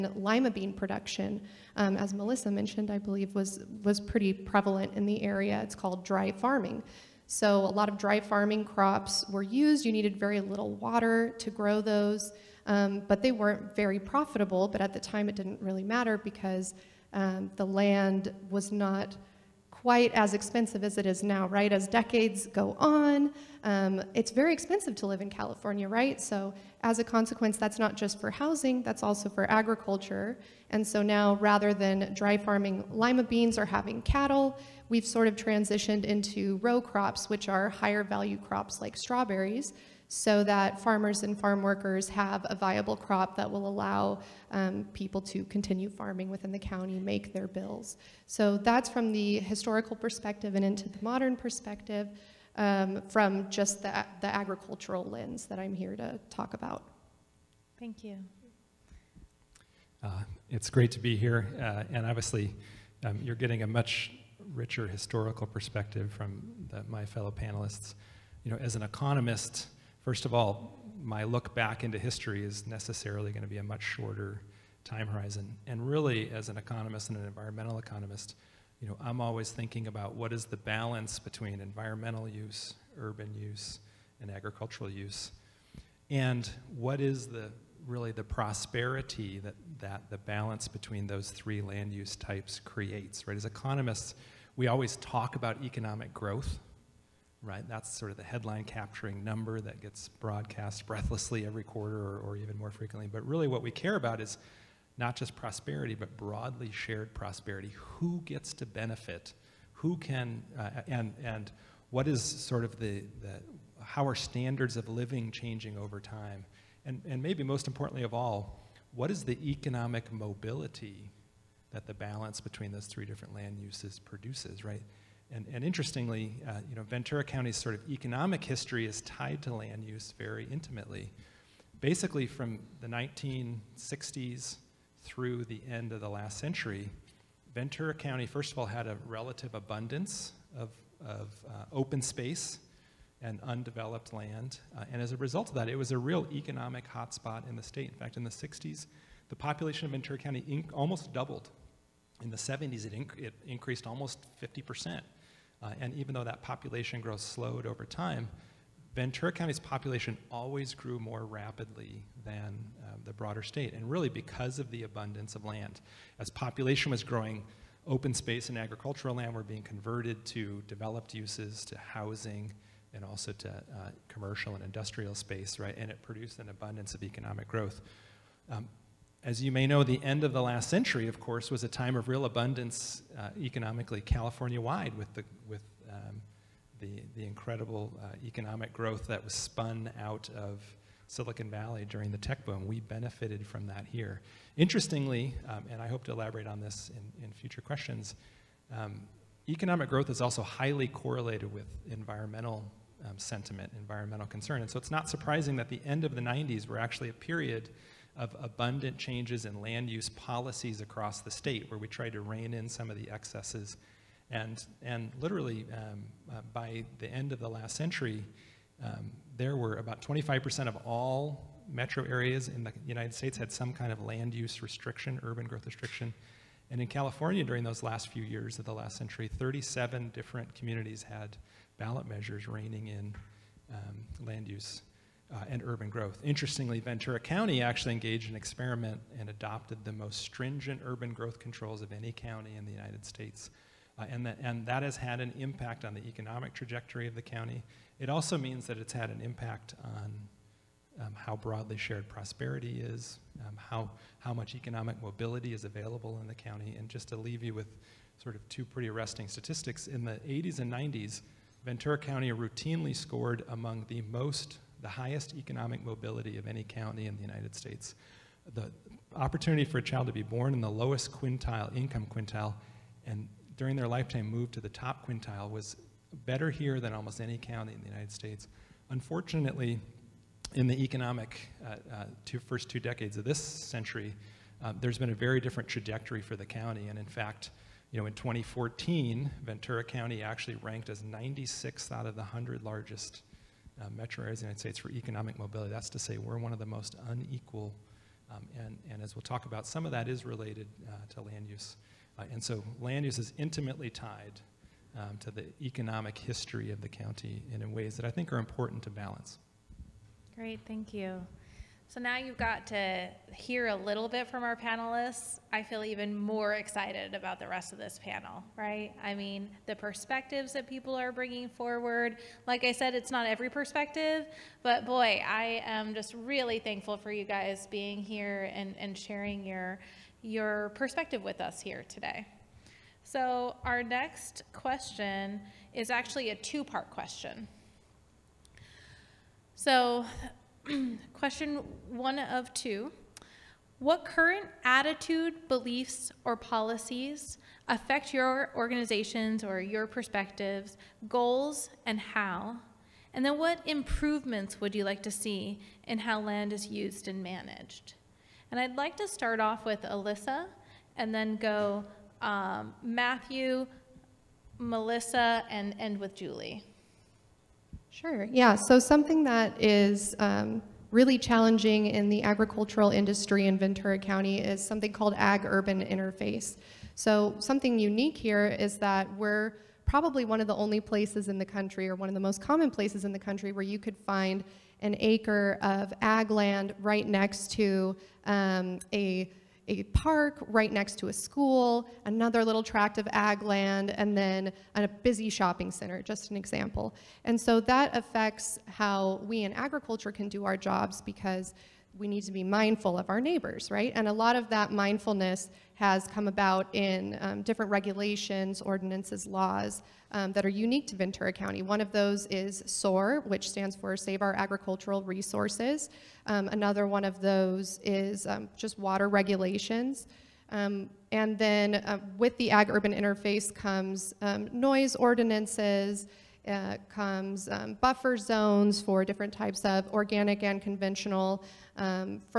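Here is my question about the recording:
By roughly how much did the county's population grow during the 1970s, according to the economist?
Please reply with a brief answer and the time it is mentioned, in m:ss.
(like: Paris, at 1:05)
Almost 50 percent, at 2:33.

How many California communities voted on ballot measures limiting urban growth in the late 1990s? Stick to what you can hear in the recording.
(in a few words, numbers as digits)
37.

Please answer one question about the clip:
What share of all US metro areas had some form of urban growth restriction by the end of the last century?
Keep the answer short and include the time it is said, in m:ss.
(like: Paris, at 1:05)
About 25%, at 3:40.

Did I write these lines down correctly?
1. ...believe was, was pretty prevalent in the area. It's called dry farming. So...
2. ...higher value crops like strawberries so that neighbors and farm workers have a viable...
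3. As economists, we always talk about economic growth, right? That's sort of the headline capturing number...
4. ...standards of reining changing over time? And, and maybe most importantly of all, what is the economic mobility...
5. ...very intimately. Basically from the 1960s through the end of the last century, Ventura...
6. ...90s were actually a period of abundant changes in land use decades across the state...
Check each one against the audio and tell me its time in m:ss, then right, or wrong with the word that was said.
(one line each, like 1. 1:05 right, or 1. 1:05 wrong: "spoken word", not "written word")
1. 0:02 right
2. 0:37 wrong: "farmers", not "neighbors"
3. 1:33 right
4. 1:54 wrong: "living", not "reining"
5. 2:10 right
6. 3:26 wrong: "policies", not "decades".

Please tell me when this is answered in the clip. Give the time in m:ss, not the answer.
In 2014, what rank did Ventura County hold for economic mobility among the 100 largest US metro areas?
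4:51.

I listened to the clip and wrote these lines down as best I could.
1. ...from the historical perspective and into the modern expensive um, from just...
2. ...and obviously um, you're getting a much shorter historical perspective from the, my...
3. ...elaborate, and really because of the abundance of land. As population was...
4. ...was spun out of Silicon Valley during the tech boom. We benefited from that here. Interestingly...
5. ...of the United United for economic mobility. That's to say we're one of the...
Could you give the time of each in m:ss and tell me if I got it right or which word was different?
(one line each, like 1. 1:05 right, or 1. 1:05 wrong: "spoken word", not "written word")
1. 0:48 wrong: "perspective", not "expensive"
2. 1:01 wrong: "richer", not "shorter"
3. 2:43 wrong: "state", not "elaborate"
4. 3:09 right
5. 4:54 wrong: "States", not "United".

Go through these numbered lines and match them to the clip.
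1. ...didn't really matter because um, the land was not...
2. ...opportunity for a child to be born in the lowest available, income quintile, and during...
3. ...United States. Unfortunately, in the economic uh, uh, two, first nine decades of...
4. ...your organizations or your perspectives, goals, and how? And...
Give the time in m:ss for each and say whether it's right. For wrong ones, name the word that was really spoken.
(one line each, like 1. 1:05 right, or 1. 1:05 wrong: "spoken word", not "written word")
1. 0:15 right
2. 4:29 wrong: "quintile", not "available"
3. 4:37 wrong: "two", not "nine"
4. 5:48 right.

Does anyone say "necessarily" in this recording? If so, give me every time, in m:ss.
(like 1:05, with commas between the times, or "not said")
1:12.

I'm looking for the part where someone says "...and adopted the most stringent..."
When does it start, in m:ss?
3:59.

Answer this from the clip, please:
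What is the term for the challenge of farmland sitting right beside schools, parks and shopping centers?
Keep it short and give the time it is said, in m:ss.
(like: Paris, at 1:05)
Ag Urban Interface, at 6:15.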